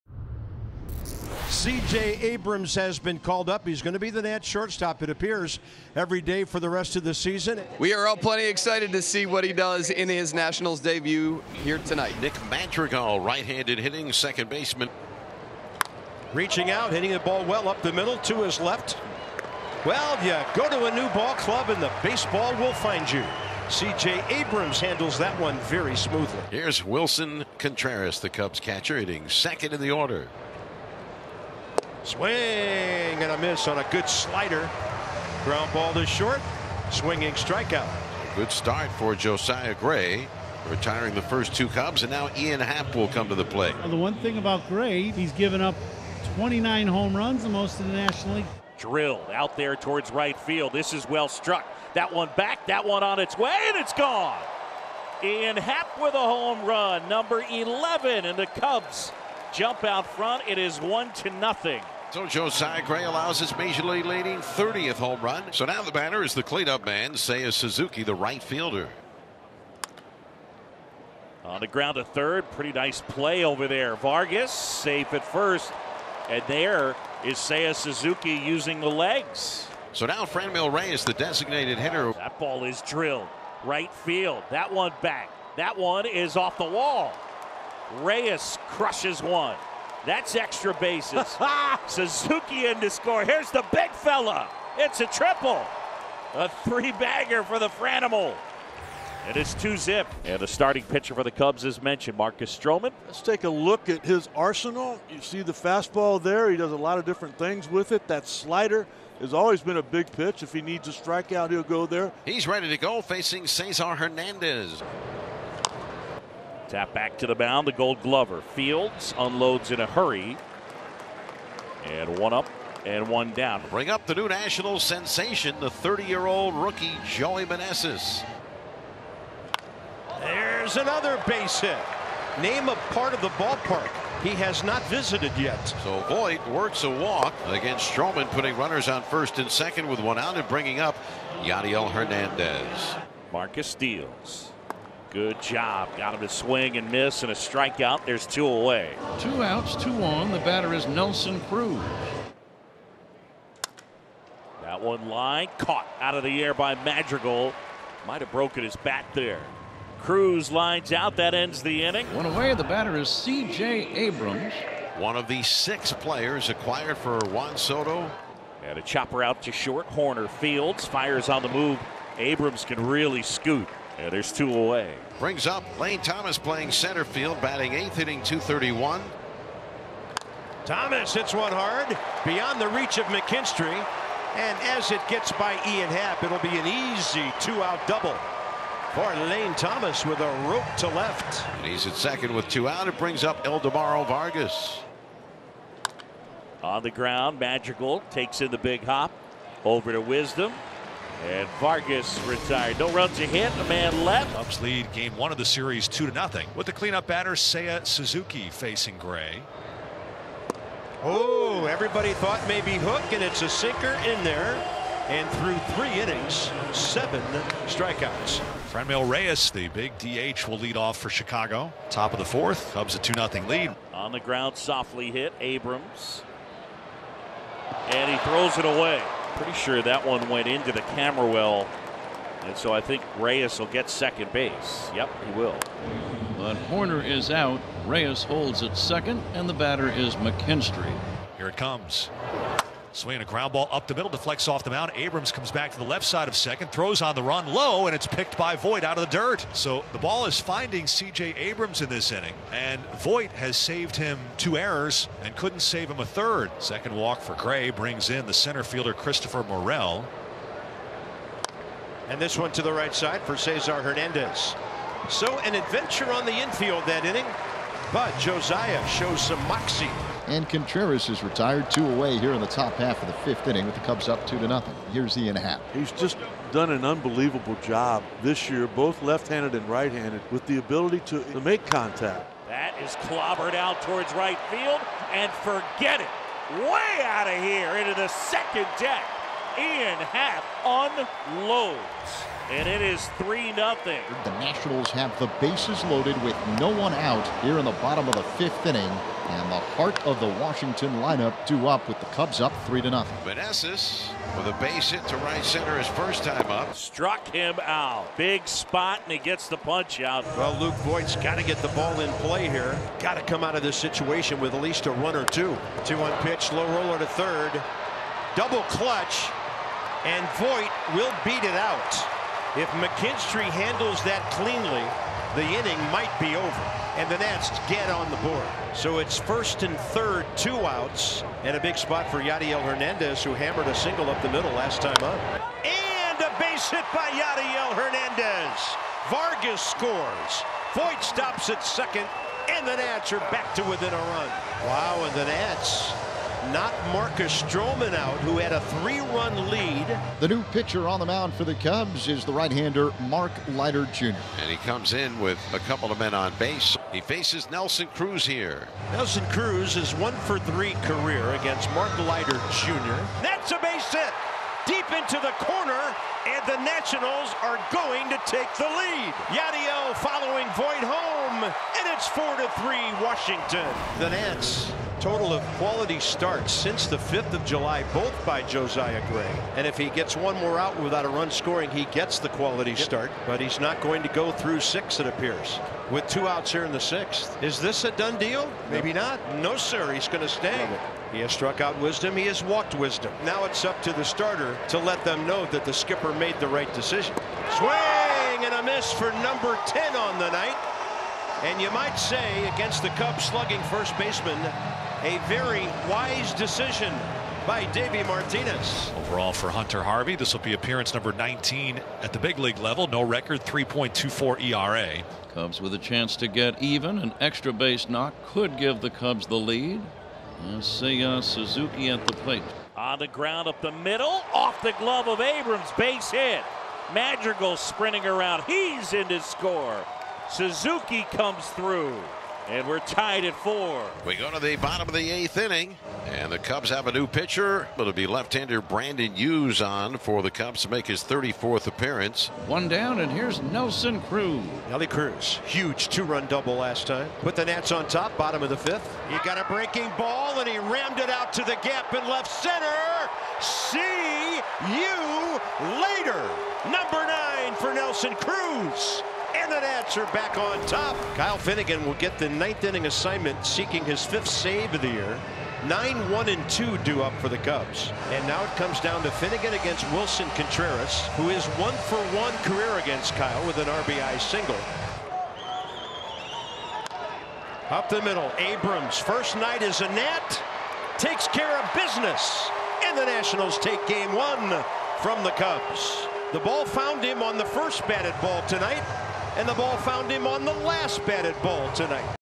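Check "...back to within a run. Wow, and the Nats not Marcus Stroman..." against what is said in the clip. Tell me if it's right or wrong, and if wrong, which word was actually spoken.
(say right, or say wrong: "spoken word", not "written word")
right.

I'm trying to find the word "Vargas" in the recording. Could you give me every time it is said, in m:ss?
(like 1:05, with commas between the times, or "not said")
1:13, 3:14, 3:21, 5:39.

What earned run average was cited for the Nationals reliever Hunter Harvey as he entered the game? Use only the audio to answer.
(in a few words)
3.24.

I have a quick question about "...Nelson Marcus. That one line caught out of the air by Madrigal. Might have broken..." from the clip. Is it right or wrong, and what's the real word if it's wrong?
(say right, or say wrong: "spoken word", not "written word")
wrong: "Cruz", not "Marcus".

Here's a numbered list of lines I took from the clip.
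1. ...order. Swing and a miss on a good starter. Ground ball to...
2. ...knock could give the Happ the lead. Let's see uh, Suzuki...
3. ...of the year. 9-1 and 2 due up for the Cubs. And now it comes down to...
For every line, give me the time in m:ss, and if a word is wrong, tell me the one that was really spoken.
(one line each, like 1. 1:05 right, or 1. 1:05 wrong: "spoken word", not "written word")
1. 0:29 wrong: "slider", not "starter"
2. 6:57 wrong: "Cubs", not "Happ"
3. 7:44 right.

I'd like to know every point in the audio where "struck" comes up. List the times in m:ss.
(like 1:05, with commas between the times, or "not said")
0:51, 5:06, 6:31.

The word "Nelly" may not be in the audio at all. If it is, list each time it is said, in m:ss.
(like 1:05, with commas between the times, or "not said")
7:24.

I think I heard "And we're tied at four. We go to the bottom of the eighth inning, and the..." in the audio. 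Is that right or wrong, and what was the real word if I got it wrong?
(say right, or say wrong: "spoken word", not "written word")
right.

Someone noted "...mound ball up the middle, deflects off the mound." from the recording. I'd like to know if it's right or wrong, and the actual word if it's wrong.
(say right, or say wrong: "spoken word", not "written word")
wrong: "ground", not "mound".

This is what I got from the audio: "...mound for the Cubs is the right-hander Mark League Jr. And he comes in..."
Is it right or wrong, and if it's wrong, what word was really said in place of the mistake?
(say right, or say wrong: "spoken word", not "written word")
wrong: "Leiter", not "League".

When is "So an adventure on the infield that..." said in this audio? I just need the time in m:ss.
4:25.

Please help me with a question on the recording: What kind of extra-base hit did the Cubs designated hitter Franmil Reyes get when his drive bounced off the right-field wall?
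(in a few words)
Triple.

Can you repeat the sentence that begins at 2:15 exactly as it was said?
So Voit works a walk against Stroman, putting runners on first and second with one out and bringing up Yadiel Hernandez.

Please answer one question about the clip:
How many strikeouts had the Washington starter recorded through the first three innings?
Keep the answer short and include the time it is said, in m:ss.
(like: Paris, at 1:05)
7, at 3:36.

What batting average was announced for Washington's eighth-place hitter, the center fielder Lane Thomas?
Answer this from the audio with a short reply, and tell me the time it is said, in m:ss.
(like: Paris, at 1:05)
231, at 2:58.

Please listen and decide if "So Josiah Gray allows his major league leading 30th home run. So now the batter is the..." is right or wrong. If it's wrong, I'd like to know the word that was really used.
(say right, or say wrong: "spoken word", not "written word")
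right.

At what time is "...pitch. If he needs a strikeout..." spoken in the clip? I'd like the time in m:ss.
1:50.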